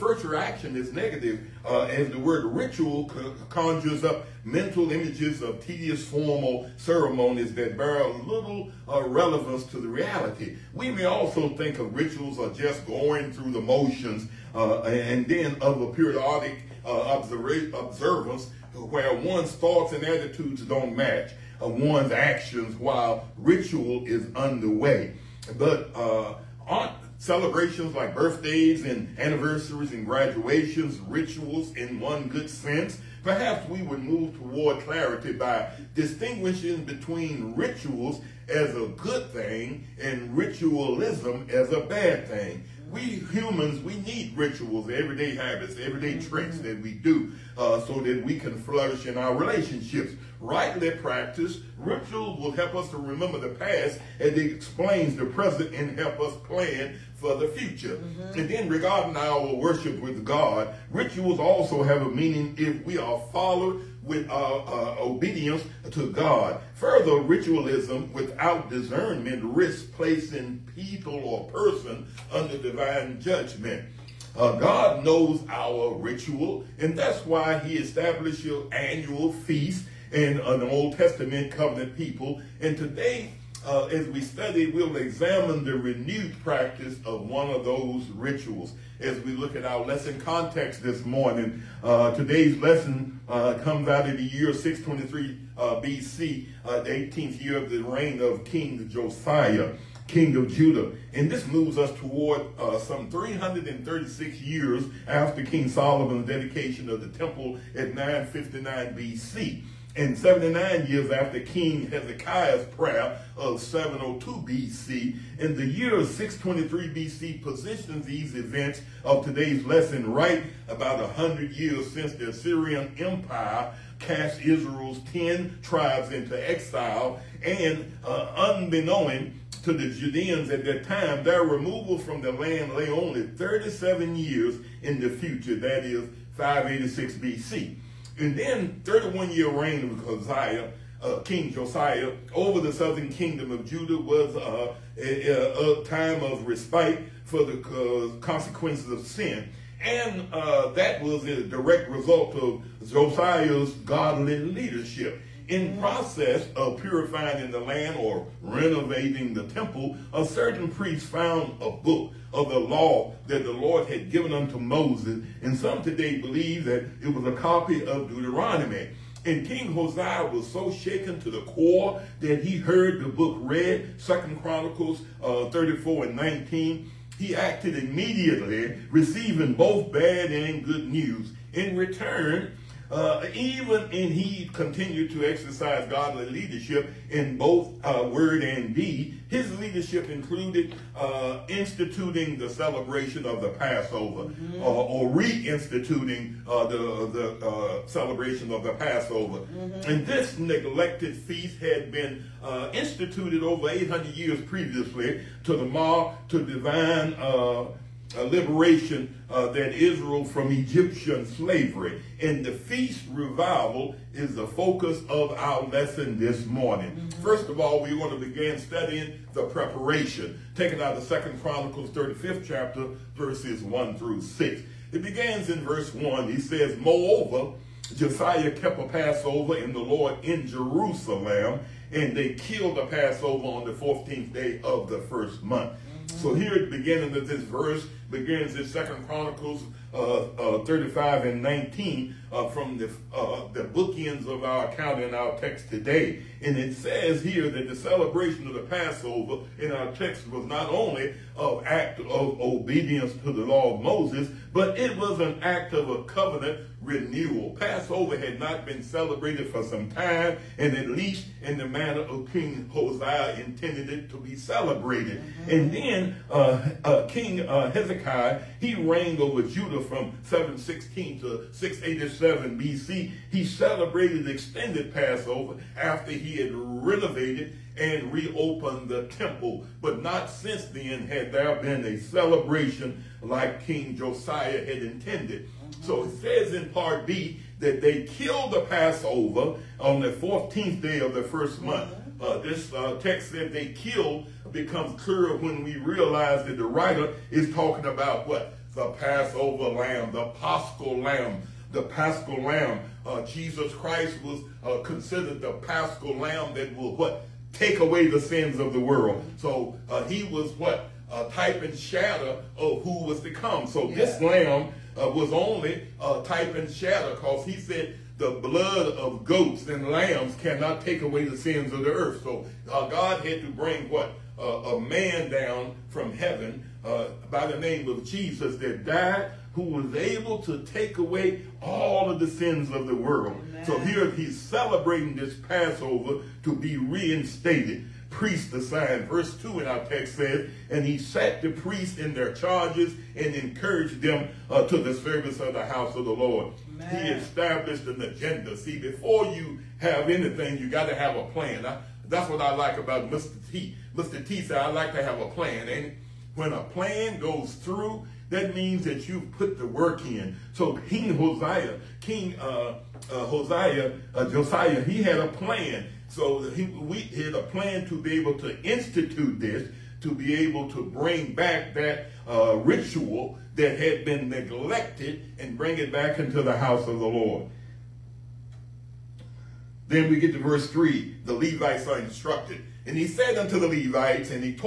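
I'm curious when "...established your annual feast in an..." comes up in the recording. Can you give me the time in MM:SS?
01:17.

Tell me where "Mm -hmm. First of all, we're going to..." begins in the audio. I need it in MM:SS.
03:36.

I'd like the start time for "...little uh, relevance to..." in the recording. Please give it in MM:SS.
00:08.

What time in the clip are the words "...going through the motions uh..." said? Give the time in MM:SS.
00:12.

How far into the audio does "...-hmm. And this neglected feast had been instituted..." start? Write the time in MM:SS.
03:19.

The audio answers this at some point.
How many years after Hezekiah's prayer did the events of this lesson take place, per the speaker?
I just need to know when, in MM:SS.
01:50.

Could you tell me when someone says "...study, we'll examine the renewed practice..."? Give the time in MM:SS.
01:24.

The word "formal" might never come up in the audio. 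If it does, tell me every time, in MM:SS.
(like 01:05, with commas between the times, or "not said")
00:06.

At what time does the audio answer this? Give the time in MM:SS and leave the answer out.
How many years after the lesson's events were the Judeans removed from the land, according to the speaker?
02:13.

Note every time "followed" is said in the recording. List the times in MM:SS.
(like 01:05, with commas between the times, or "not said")
01:03.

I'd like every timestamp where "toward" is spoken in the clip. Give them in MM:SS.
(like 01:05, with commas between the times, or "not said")
00:34, 01:41.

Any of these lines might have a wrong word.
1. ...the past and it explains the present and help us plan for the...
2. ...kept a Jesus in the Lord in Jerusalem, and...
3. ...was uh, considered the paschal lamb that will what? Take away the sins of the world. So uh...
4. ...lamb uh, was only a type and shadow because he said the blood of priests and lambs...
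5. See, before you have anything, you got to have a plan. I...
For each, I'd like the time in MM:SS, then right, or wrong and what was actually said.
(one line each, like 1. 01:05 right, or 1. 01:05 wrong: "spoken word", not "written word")
1. 00:53 right
2. 03:48 wrong: "Passover", not "Jesus"
3. 05:04 right
4. 05:14 wrong: "goats", not "priests"
5. 05:48 right.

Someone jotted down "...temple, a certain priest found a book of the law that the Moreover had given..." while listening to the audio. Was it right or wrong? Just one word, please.
wrong.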